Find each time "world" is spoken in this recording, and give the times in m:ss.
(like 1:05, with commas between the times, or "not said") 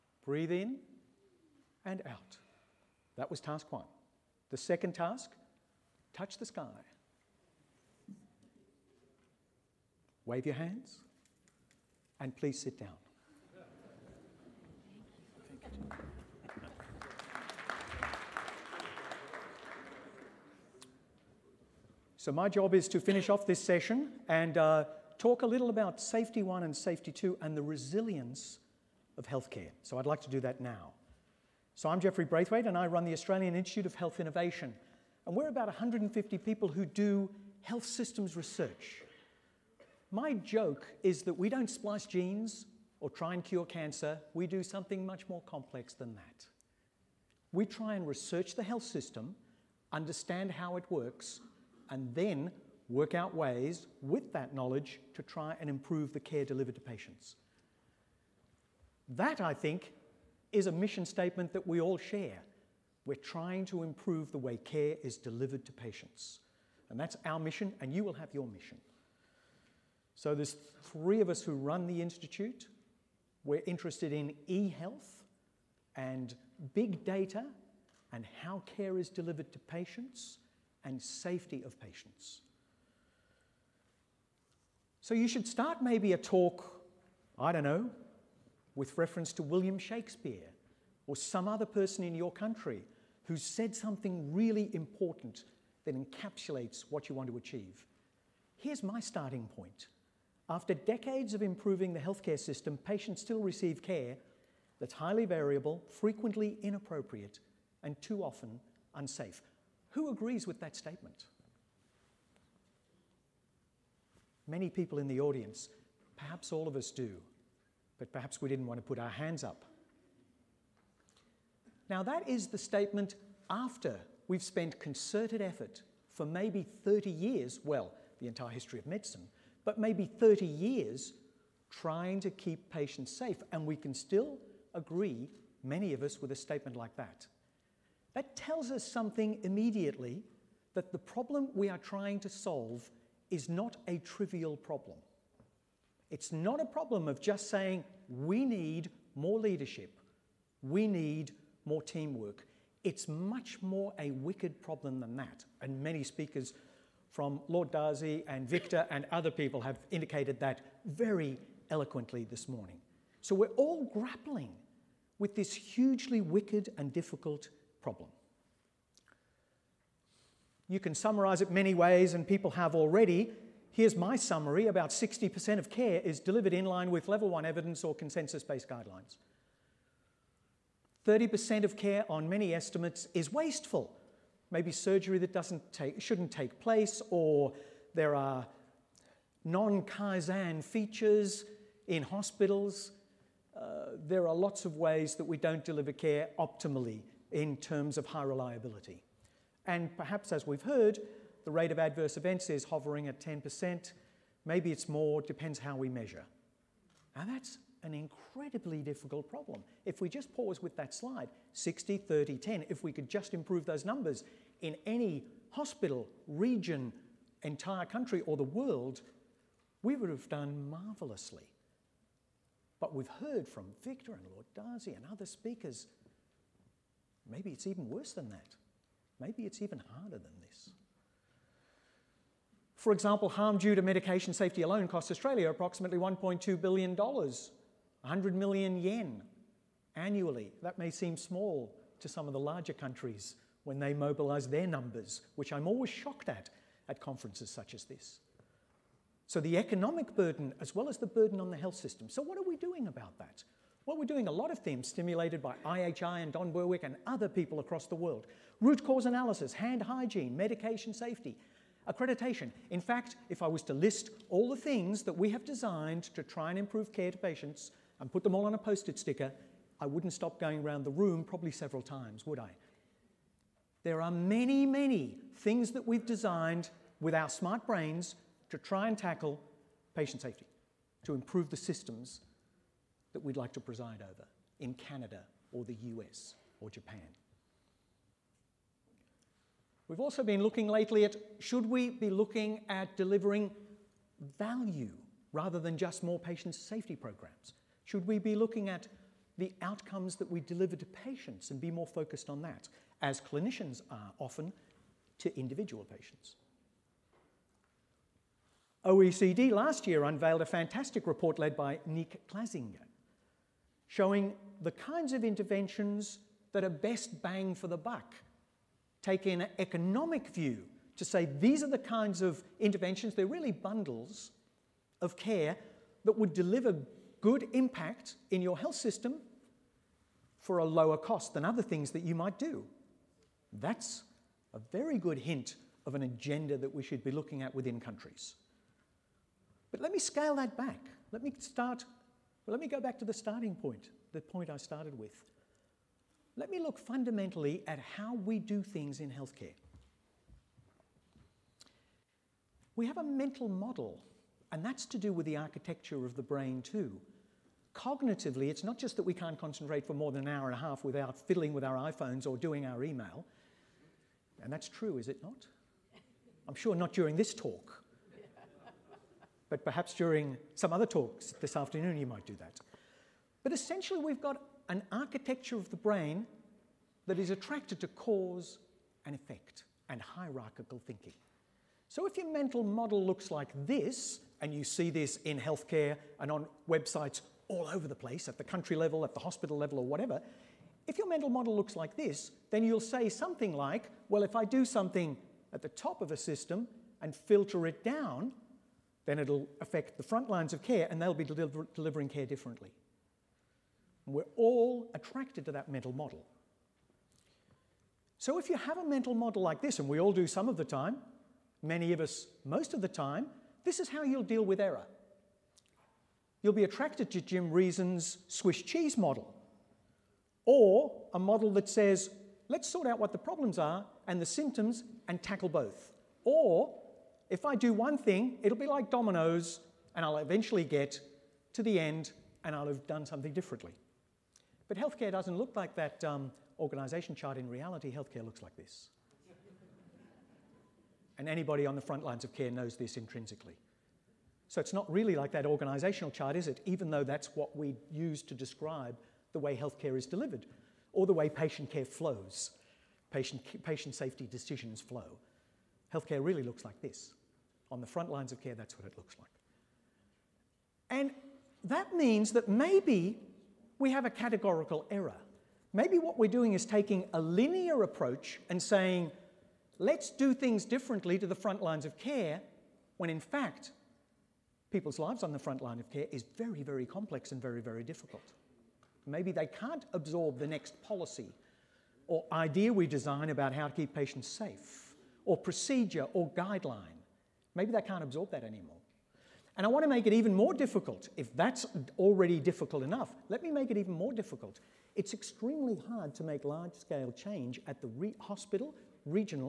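3:38, 4:17.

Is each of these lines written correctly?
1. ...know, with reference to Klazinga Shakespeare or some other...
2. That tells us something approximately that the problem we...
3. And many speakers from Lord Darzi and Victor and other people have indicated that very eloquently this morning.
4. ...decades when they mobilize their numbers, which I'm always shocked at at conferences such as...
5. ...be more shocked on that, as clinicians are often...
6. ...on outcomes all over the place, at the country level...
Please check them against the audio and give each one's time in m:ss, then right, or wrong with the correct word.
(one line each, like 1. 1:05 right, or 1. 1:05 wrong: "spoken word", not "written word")
1. 1:27 wrong: "William", not "Klazinga"
2. 2:18 wrong: "immediately", not "approximately"
3. 2:35 right
4. 4:02 wrong: "countries", not "decades"
5. 5:01 wrong: "focused", not "shocked"
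6. 6:26 wrong: "websites", not "outcomes".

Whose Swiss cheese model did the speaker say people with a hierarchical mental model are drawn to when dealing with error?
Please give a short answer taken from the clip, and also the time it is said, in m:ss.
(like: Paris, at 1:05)
Jim Reason, at 6:57.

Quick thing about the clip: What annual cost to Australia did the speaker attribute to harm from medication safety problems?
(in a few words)
$1.2 billion.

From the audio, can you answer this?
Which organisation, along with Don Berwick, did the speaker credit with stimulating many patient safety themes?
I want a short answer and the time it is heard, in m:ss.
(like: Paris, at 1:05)
IHI, at 4:15.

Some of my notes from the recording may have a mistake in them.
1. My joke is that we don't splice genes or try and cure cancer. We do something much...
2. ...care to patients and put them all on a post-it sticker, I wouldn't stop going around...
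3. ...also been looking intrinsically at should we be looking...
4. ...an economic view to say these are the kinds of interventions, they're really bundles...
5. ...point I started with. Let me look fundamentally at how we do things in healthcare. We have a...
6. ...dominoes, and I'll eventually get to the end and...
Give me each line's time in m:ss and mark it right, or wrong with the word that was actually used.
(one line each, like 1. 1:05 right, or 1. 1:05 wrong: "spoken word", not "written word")
1. 0:40 right
2. 4:26 right
3. 4:50 wrong: "lately", not "intrinsically"
4. 5:19 right
5. 5:44 right
6. 7:08 right.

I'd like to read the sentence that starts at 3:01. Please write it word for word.
30% of care on many estimates is wasteful.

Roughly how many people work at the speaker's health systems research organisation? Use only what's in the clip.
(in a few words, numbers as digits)
150.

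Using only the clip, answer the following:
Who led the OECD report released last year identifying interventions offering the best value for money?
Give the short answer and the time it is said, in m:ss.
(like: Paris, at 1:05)
Niek Klazinga, at 5:11.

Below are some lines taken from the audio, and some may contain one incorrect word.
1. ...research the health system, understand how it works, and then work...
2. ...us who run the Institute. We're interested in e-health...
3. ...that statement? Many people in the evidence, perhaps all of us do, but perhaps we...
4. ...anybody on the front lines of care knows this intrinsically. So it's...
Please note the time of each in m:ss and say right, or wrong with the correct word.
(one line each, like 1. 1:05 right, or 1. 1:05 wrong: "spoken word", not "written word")
1. 0:48 right
2. 1:11 right
3. 1:50 wrong: "audience", not "evidence"
4. 7:21 right.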